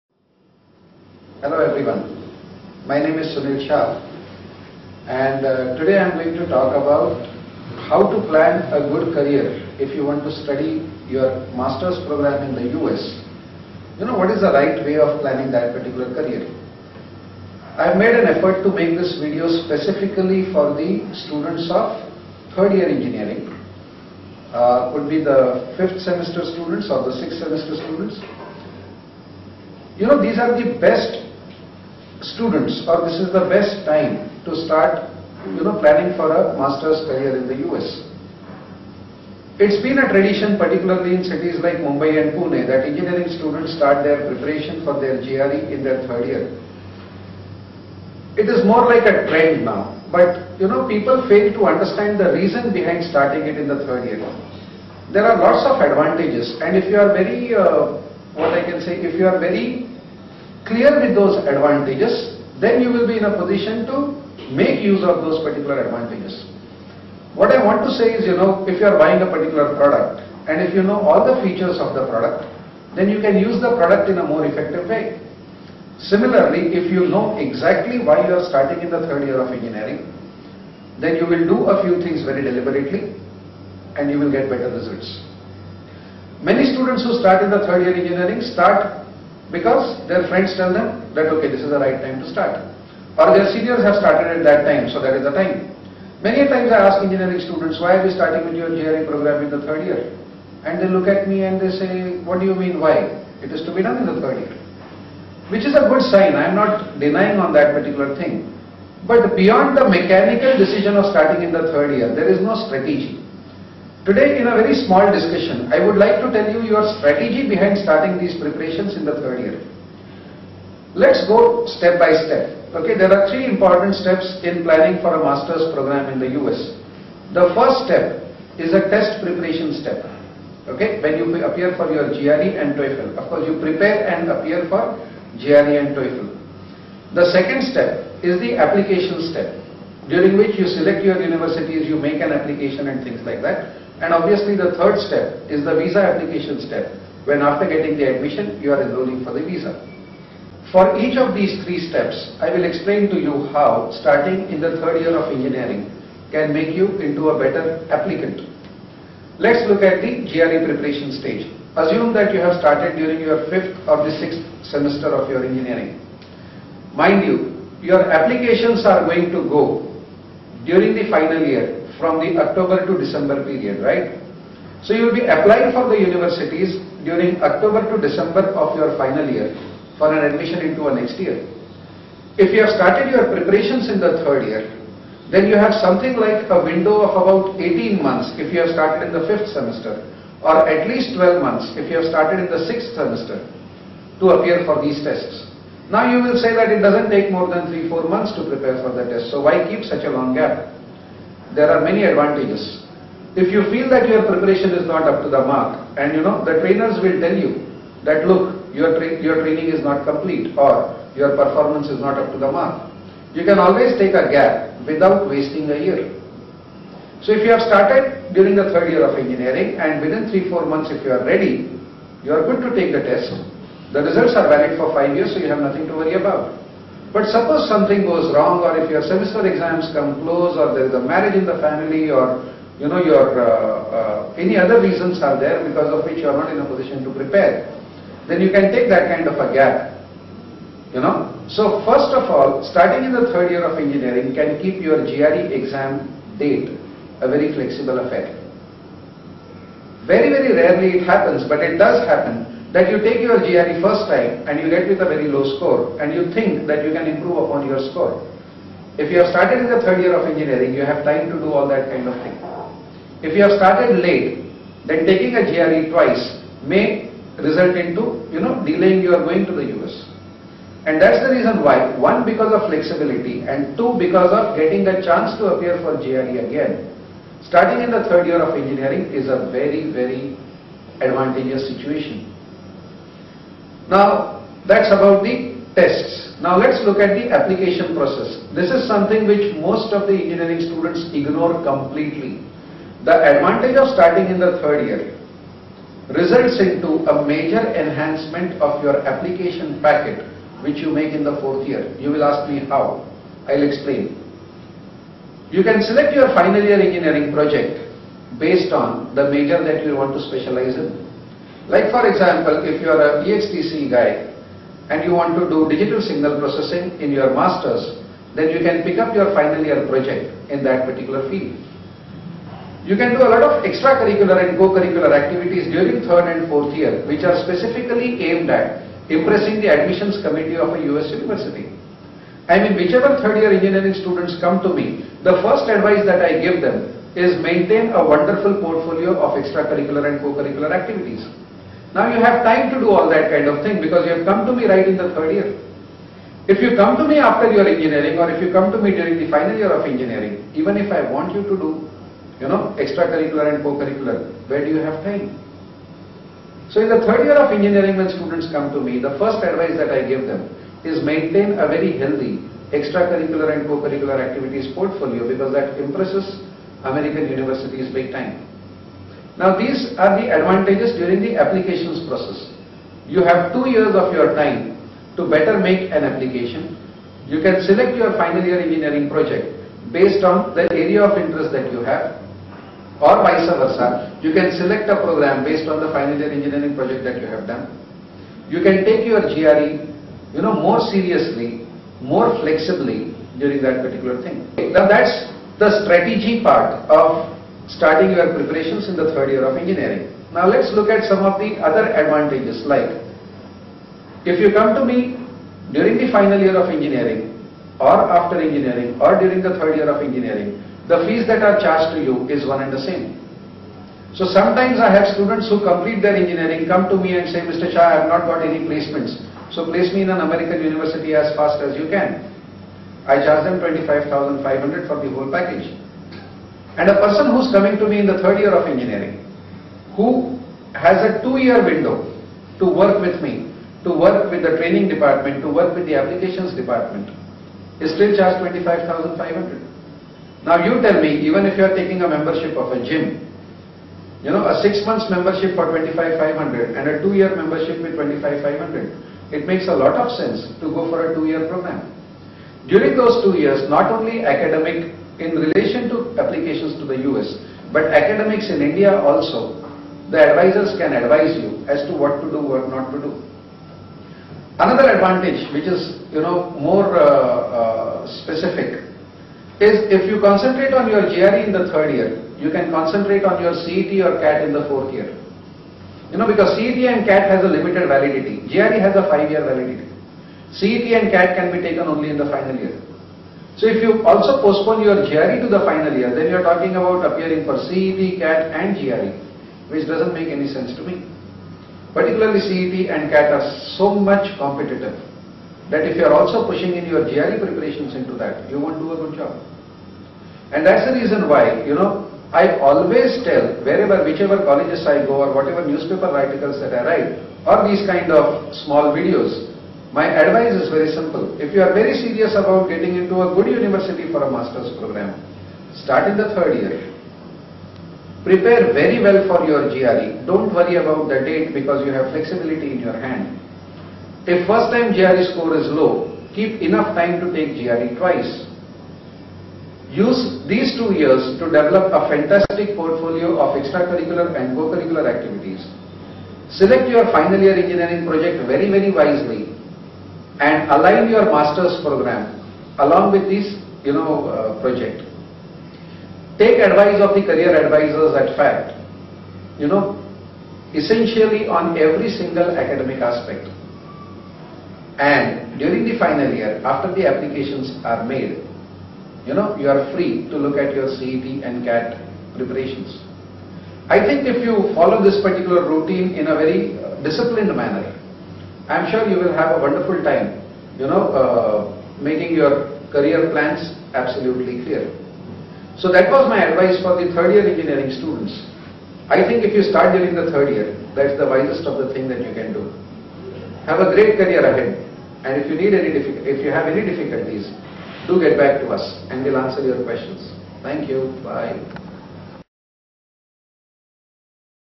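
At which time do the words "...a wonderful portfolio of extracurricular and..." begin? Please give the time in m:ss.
5:37.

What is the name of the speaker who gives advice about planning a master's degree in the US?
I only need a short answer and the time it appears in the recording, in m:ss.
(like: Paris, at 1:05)
Sunil Shah, at 0:03.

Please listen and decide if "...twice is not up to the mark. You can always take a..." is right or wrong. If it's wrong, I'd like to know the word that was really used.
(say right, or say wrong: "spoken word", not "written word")
wrong: "performance", not "twice".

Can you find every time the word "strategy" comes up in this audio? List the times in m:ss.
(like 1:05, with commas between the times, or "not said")
1:52, 1:56, 6:35.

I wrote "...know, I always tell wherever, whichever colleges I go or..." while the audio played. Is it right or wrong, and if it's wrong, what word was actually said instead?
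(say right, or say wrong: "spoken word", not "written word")
right.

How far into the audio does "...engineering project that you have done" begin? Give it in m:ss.
6:26.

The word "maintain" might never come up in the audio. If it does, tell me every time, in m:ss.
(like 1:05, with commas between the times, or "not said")
5:37, 6:01.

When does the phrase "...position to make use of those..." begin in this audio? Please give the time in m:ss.
1:03.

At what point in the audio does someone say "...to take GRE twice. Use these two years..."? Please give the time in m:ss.
8:47.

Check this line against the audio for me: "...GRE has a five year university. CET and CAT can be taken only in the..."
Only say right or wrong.
wrong.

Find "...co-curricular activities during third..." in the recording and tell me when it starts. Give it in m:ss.
5:24.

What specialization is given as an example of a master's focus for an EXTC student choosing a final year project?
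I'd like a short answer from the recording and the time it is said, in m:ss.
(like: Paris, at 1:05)
digital signal processing, at 5:15.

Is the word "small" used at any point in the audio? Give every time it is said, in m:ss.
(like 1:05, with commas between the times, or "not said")
1:54, 8:28.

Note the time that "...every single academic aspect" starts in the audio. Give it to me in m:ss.
9:11.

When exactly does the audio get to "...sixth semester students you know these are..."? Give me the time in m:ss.
0:27.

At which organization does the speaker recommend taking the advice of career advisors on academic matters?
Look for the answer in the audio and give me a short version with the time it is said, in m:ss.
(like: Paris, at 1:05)
FACT, at 9:08.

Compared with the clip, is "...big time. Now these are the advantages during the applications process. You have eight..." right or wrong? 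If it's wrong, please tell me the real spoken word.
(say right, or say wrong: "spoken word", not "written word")
wrong: "two", not "eight".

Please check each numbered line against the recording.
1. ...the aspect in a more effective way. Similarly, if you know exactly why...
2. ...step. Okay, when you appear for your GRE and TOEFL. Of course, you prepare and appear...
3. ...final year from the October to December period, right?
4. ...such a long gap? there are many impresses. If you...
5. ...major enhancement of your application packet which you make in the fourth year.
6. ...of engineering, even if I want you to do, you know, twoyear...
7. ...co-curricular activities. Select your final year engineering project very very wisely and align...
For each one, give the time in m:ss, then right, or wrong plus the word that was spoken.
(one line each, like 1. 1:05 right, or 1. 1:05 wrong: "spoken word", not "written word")
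1. 1:13 wrong: "product", not "aspect"
2. 2:09 right
3. 2:51 right
4. 3:19 wrong: "advantages", not "impresses"
5. 4:57 right
6. 5:49 wrong: "extracurricular", not "twoyear"
7. 8:54 right.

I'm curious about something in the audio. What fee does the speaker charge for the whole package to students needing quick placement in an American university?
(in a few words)
25,500.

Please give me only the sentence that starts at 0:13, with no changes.
You know what is the right way of planning that particular career?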